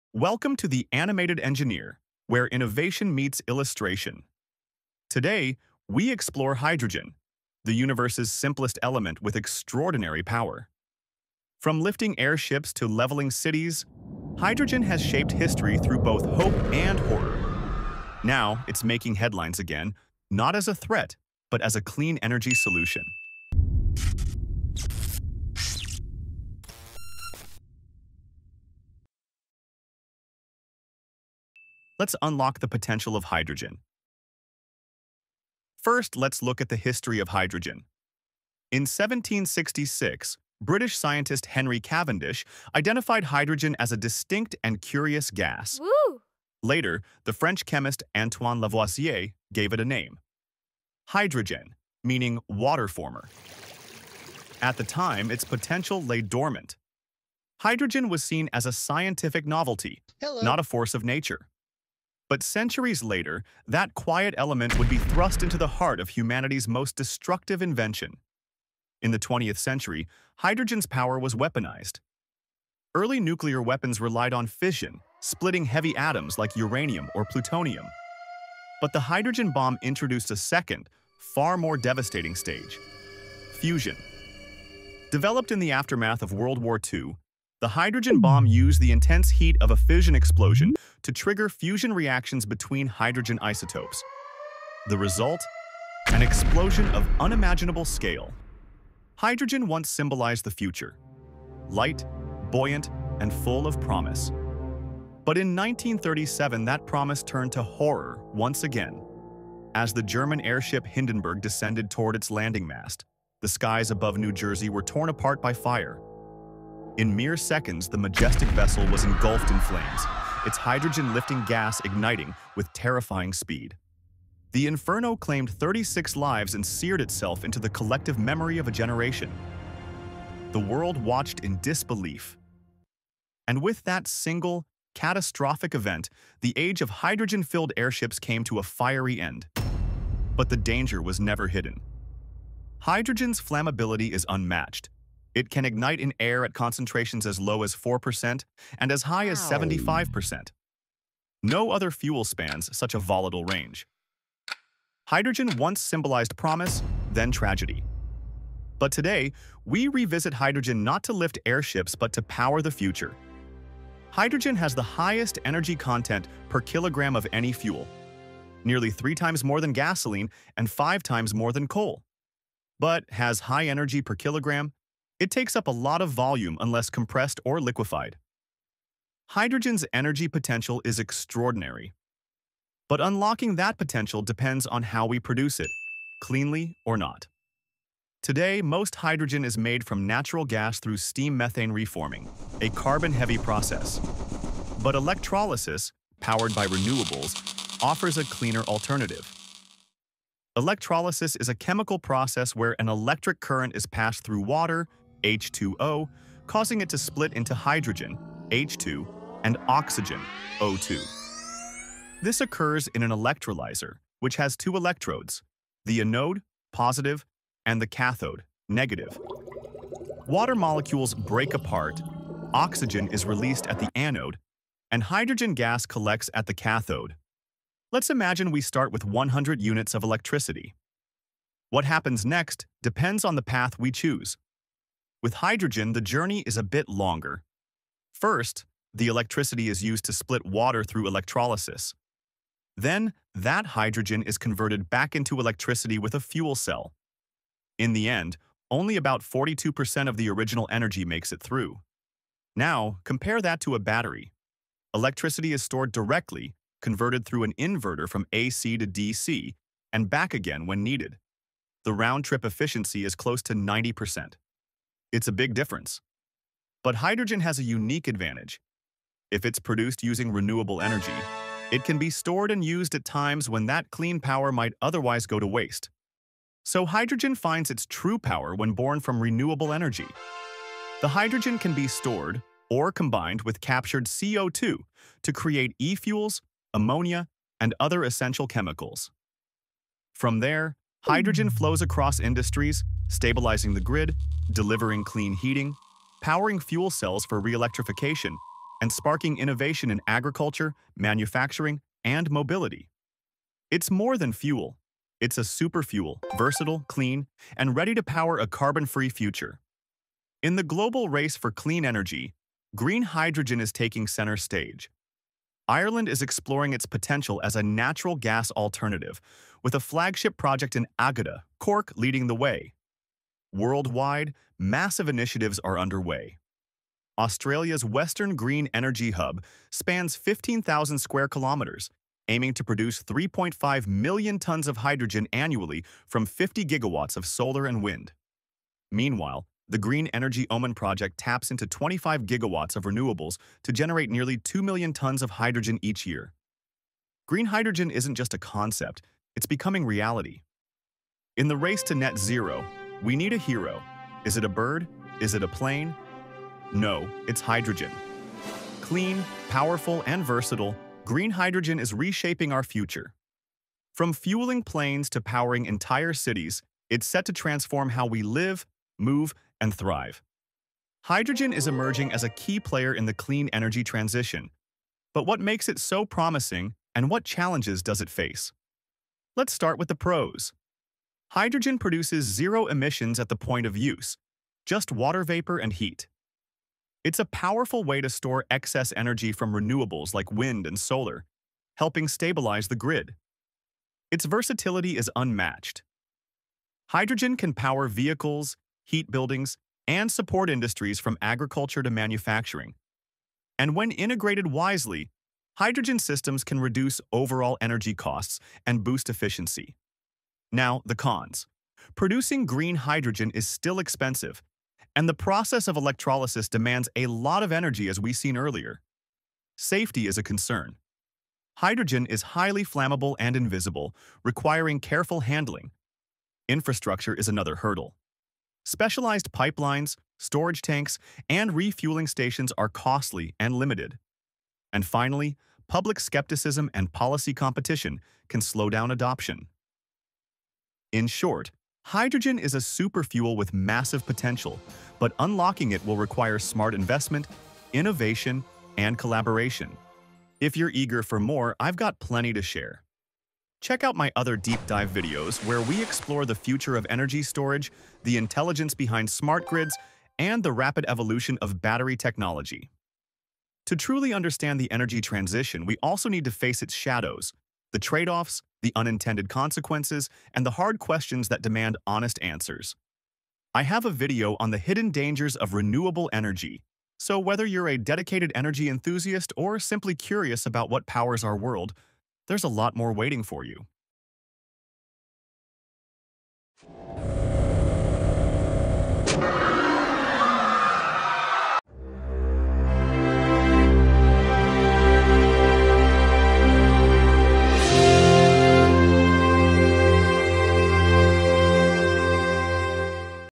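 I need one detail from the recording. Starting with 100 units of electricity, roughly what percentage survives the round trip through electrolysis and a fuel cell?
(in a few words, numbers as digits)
42%.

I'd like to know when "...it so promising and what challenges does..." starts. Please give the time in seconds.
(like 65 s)
375 s.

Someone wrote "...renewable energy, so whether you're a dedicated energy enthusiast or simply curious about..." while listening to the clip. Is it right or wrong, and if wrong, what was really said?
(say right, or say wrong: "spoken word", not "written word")
right.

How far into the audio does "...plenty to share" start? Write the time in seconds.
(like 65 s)
451 s.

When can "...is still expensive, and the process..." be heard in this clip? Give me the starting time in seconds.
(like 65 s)
413 s.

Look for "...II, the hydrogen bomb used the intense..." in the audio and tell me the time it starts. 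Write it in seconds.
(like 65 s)
86 s.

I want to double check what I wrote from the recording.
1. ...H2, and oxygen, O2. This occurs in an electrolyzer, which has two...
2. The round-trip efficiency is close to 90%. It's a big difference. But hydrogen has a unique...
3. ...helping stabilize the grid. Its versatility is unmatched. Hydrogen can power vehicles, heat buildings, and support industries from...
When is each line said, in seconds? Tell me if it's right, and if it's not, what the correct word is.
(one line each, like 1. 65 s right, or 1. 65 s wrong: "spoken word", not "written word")
1. 208 s right
2. 261 s right
3. 391 s right.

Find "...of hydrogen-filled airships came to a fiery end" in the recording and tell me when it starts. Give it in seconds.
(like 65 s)
136 s.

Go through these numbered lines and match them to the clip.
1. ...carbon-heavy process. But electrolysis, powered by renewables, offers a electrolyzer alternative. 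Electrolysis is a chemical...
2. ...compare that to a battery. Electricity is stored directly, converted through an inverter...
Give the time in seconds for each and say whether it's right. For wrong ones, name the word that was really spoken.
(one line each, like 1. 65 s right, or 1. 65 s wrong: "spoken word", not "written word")
1. 192 s wrong: "cleaner", not "electrolyzer"
2. 253 s right.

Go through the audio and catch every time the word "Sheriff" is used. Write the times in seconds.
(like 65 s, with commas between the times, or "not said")
not said.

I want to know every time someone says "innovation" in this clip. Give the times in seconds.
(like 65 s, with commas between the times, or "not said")
2 s, 299 s, 447 s.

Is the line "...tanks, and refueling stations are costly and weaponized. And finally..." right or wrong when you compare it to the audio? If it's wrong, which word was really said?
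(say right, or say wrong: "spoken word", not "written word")
wrong: "limited", not "weaponized".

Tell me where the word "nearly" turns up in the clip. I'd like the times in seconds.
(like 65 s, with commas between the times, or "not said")
168 s, 344 s.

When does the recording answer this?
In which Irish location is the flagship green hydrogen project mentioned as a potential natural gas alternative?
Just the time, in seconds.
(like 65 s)
320 s.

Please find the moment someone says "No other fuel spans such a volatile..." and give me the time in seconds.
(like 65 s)
151 s.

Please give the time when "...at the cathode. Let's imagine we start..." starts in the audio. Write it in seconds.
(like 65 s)
226 s.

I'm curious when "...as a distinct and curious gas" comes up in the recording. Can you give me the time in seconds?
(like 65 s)
43 s.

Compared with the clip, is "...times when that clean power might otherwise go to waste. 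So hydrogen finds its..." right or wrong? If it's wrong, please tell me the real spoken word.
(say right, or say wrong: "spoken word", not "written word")
right.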